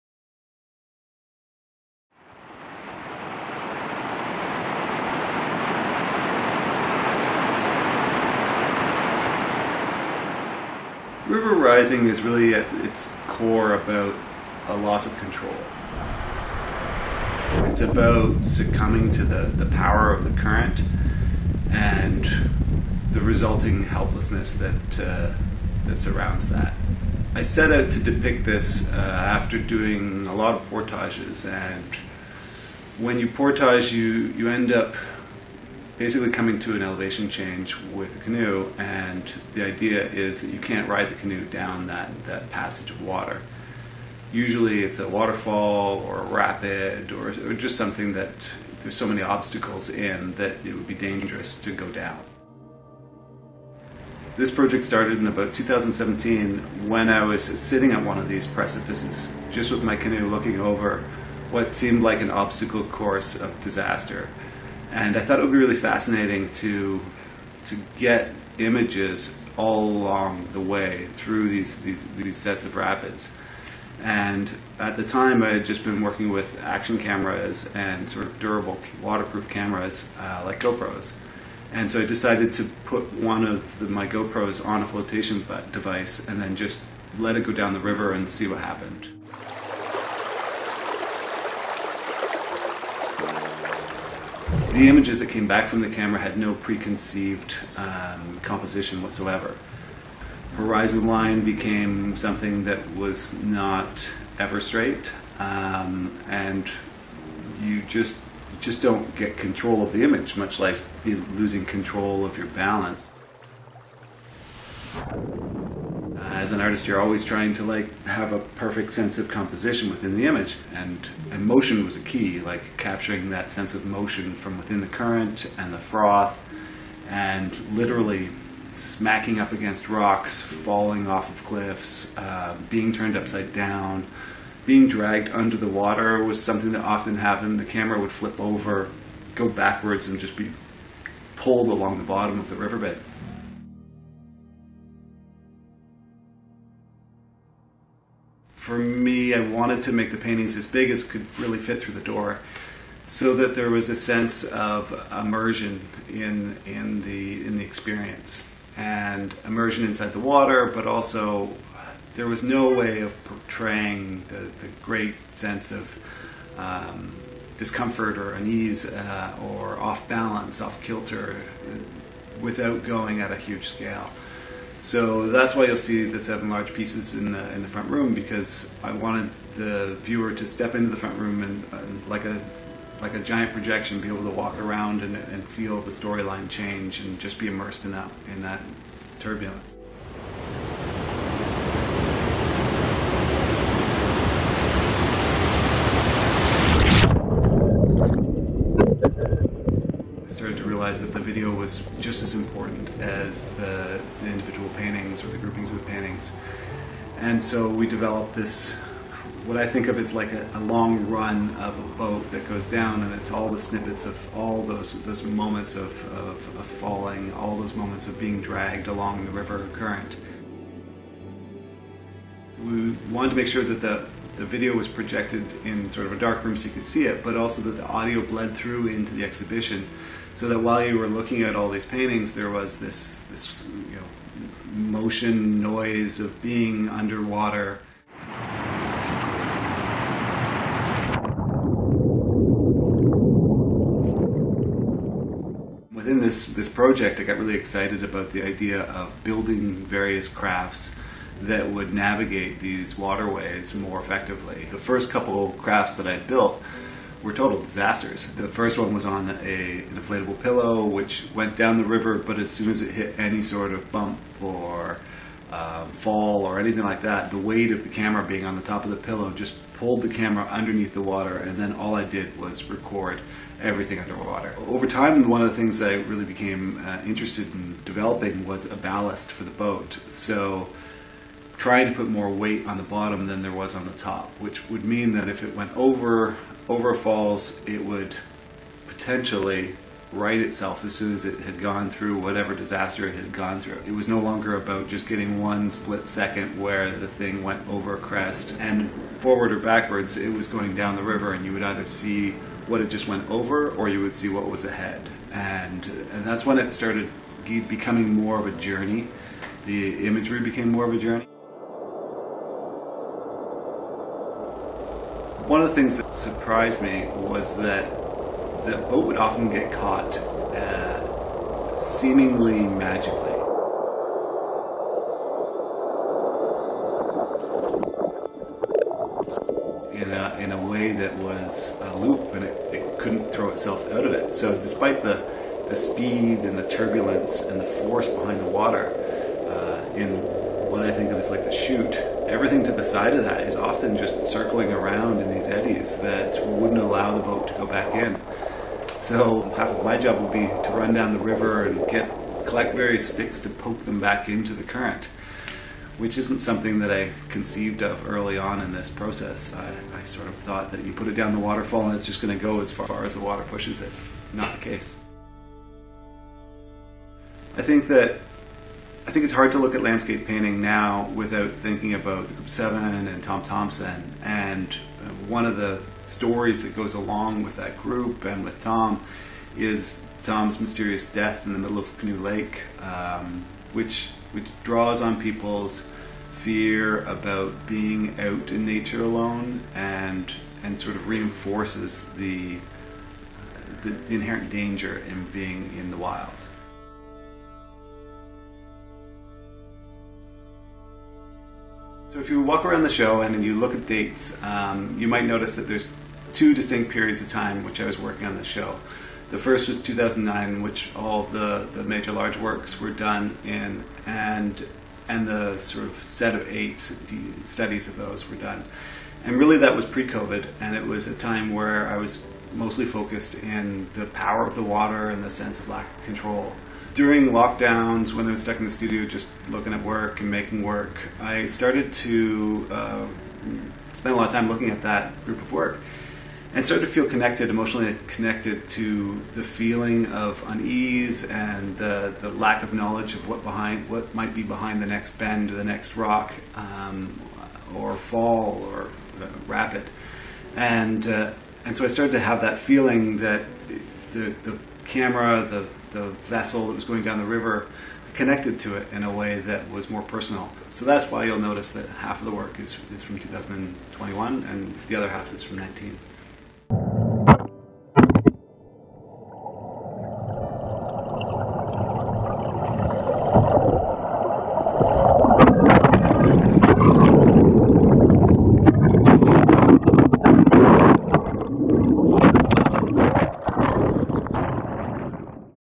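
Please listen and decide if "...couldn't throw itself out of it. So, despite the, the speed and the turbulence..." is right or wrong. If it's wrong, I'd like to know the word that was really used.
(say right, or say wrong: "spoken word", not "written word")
right.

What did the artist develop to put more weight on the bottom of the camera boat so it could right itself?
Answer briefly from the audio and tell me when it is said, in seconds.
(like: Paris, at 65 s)
a ballast, at 278 s.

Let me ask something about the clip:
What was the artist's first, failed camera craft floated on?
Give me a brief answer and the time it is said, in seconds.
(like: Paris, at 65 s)
an inflatable pillow, at 259 s.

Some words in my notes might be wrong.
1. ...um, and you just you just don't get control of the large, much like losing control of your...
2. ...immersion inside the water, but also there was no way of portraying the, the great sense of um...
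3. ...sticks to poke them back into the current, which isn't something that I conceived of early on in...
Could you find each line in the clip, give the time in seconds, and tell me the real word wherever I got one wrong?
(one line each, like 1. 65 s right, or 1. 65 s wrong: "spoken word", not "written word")
1. 105 s wrong: "image", not "large"
2. 159 s right
3. 353 s right.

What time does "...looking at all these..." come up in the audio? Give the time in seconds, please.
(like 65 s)
231 s.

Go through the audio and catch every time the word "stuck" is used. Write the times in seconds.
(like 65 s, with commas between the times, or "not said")
428 s.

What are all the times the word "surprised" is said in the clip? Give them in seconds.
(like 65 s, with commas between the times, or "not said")
316 s.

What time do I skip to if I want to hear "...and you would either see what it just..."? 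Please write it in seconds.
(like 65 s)
301 s.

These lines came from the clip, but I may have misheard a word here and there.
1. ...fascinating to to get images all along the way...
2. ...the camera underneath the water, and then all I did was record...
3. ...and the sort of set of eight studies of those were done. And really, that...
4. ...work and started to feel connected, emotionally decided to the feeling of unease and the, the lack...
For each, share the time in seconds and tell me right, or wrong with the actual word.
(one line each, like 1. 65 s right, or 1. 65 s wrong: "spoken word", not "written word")
1. 65 s right
2. 270 s right
3. 415 s right
4. 435 s wrong: "connected", not "decided".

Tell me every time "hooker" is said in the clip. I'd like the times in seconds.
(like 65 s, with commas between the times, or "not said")
not said.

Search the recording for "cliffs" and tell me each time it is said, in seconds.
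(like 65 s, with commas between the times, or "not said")
131 s.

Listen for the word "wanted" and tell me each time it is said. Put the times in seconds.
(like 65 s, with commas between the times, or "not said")
149 s, 178 s, 223 s.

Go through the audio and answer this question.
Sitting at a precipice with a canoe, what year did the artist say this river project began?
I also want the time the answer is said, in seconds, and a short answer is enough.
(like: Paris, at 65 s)
2017, at 55 s.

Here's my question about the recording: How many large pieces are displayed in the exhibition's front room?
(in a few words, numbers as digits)
7.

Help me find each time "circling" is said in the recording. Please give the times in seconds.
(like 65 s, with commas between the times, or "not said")
344 s.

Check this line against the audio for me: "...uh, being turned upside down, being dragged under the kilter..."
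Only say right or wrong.
wrong.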